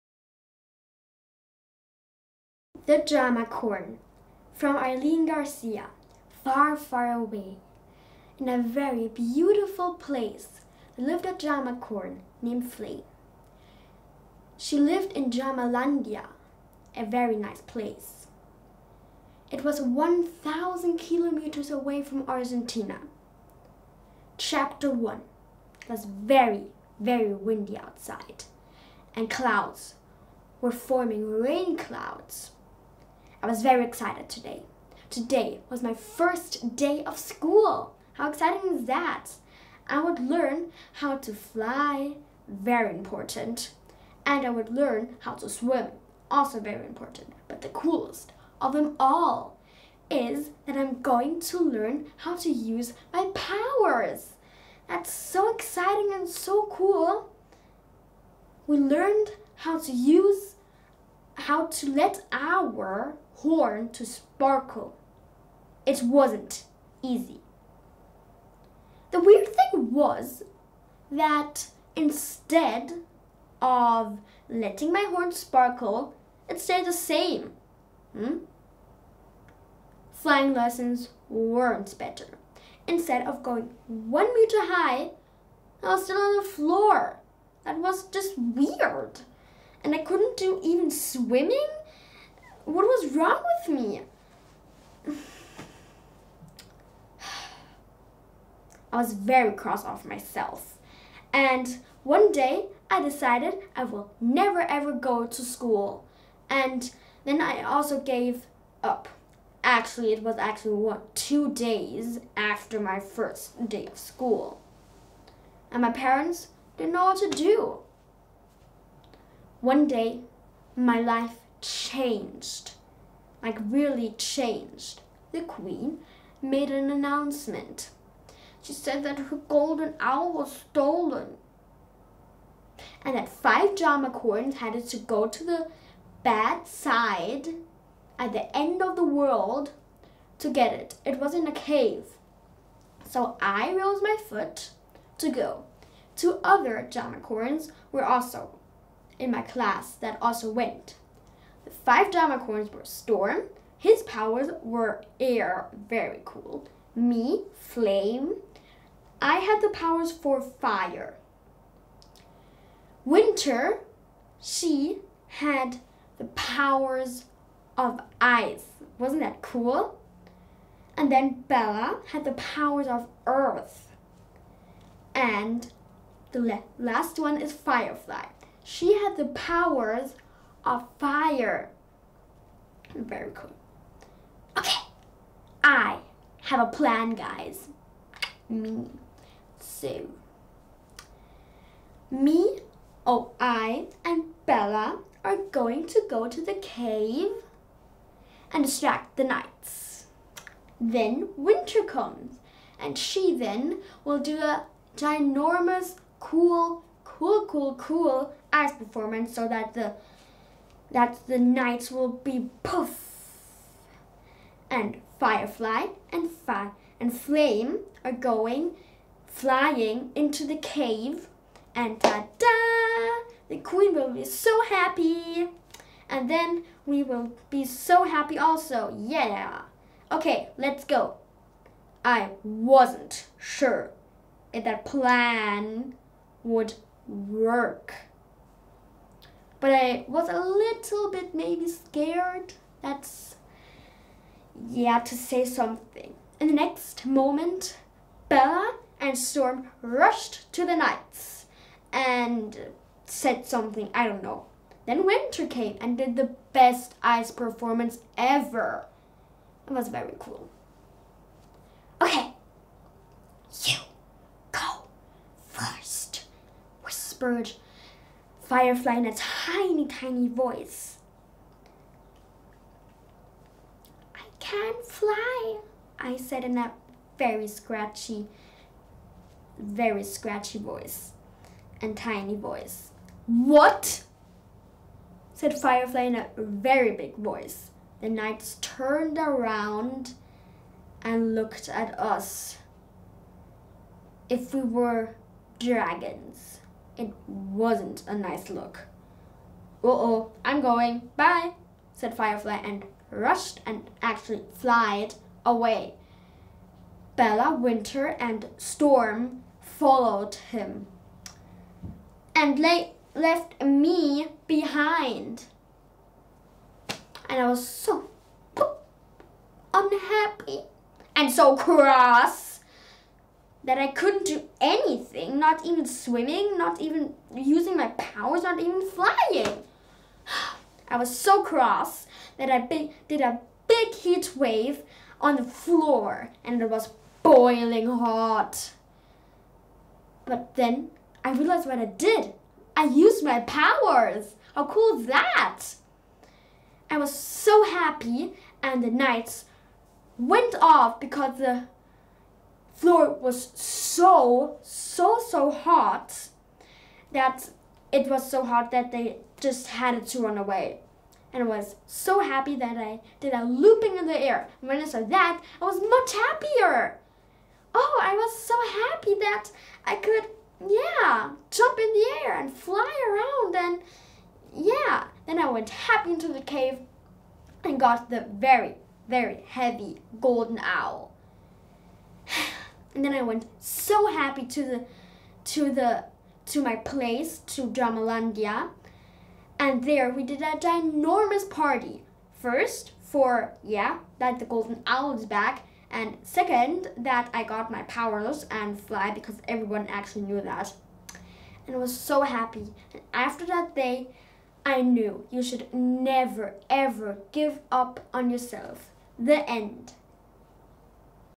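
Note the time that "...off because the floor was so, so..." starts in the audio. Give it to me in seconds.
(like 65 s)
350 s.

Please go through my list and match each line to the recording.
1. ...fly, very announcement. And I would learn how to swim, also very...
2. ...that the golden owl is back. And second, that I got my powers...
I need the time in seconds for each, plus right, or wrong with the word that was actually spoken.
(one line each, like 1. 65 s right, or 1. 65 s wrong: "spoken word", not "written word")
1. 41 s wrong: "important", not "announcement"
2. 394 s right.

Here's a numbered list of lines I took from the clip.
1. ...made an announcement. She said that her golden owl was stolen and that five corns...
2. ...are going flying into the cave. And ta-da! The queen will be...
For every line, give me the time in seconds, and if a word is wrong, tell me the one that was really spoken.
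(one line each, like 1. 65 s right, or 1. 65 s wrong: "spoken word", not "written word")
1. 126 s right
2. 218 s right.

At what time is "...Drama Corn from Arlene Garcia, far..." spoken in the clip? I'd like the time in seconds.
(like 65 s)
2 s.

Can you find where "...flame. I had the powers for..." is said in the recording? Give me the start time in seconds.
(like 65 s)
157 s.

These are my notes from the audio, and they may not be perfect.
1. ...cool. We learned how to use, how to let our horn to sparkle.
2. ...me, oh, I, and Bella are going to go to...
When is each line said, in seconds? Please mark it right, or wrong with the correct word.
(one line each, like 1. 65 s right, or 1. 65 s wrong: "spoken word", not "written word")
1. 56 s right
2. 192 s right.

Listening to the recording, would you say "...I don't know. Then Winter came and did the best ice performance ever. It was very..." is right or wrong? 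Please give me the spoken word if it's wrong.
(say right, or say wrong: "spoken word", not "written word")
right.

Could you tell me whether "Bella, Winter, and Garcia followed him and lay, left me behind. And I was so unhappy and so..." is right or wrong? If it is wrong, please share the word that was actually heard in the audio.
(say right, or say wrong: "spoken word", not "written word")
wrong: "Storm", not "Garcia".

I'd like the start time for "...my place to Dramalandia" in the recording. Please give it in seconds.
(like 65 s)
386 s.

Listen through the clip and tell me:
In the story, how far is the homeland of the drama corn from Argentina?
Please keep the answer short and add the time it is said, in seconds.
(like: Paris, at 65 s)
1,000 kilometers, at 19 s.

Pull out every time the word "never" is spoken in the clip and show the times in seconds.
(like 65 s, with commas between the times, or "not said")
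104 s, 405 s.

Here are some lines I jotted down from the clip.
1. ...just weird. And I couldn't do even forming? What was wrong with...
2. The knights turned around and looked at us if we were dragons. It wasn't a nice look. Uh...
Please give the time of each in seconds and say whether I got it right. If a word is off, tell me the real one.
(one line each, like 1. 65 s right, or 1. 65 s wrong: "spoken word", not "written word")
1. 88 s wrong: "swimming", not "forming"
2. 288 s right.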